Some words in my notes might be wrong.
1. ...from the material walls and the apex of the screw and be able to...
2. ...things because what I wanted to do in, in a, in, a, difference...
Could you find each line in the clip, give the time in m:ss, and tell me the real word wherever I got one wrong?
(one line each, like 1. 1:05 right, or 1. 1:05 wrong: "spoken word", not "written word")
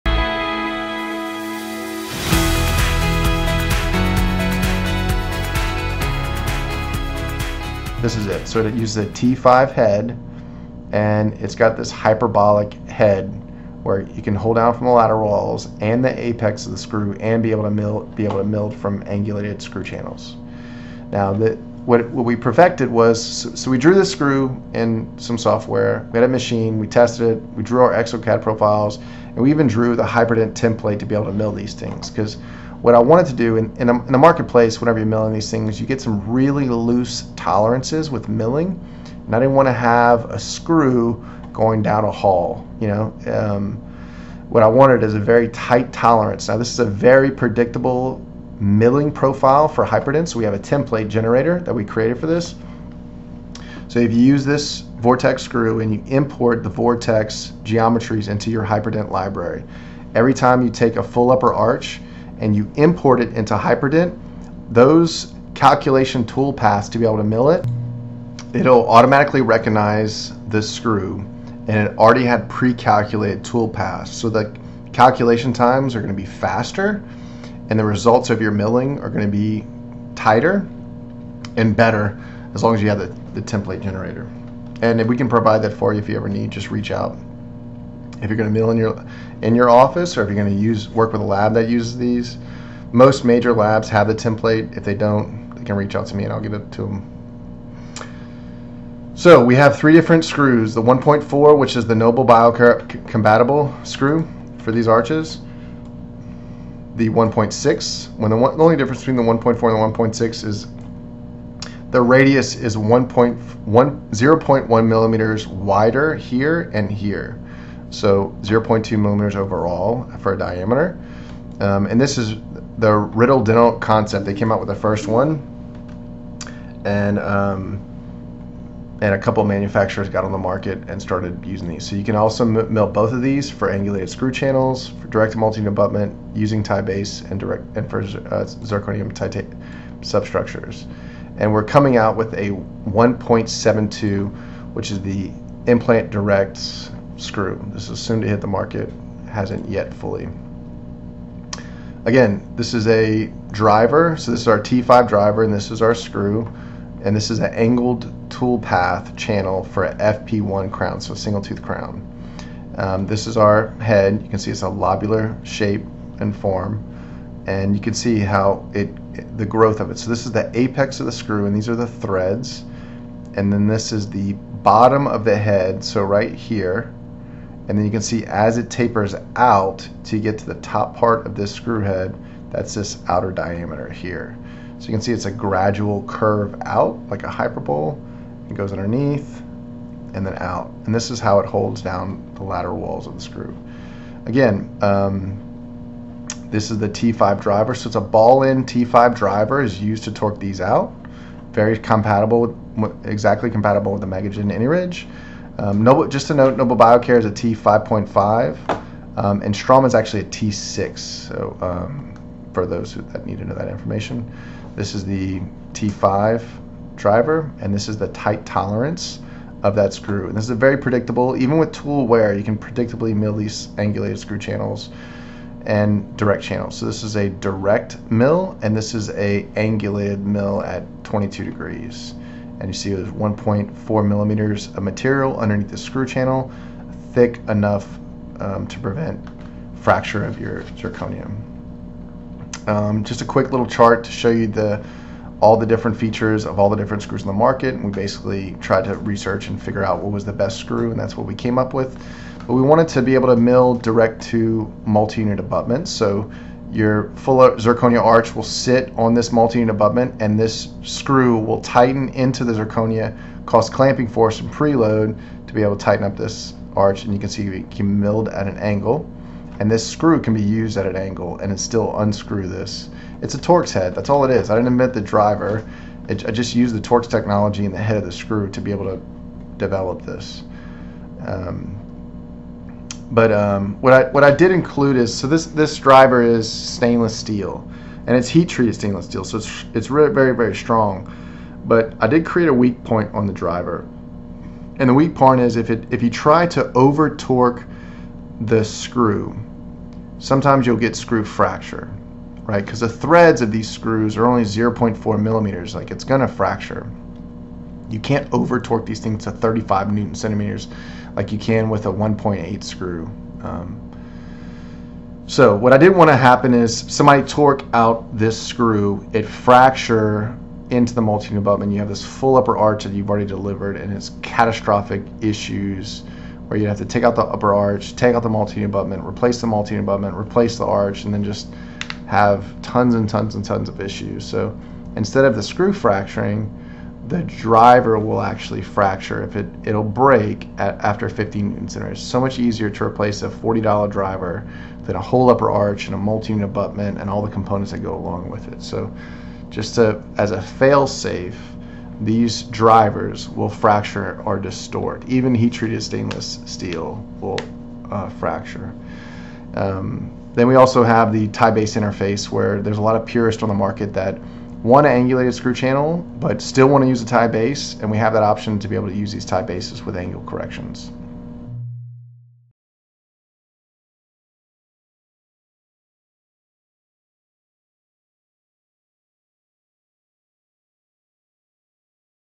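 1. 0:14 wrong: "lateral", not "material"
2. 0:31 wrong: "marketplace", not "difference".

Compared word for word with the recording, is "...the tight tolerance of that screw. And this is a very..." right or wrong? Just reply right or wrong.
right.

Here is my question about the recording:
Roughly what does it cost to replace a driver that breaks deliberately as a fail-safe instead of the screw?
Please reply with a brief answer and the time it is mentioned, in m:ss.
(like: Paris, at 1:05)
$40, at 5:43.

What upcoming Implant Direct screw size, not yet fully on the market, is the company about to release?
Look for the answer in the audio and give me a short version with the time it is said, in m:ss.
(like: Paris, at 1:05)
1.72, at 2:22.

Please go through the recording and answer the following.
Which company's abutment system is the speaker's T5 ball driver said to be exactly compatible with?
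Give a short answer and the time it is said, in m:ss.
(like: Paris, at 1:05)
MegaGen AnyRidge, at 3:24.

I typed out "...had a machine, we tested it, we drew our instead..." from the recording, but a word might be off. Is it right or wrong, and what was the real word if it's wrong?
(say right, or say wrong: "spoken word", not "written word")
wrong: "exocad", not "instead".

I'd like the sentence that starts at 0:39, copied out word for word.
And I didn't want to have a screw going down a hall.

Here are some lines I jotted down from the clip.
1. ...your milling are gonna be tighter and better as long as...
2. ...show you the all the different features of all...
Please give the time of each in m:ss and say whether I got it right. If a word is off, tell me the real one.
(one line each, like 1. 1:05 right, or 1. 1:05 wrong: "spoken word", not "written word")
1. 1:18 right
2. 4:04 right.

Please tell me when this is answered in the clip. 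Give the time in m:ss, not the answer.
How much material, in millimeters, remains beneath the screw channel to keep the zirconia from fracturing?
3:53.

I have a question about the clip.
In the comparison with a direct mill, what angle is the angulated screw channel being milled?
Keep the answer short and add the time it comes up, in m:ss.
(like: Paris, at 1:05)
22 degrees, at 3:51.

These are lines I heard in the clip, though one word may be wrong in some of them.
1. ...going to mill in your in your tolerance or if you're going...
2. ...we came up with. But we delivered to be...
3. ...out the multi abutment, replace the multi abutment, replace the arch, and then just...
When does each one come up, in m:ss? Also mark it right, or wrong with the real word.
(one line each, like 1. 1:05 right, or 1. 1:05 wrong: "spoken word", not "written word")
1. 1:28 wrong: "office", not "tolerance"
2. 4:11 wrong: "wanted", not "delivered"
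3. 5:28 right.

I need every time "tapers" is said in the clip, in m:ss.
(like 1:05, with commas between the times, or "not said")
2:58.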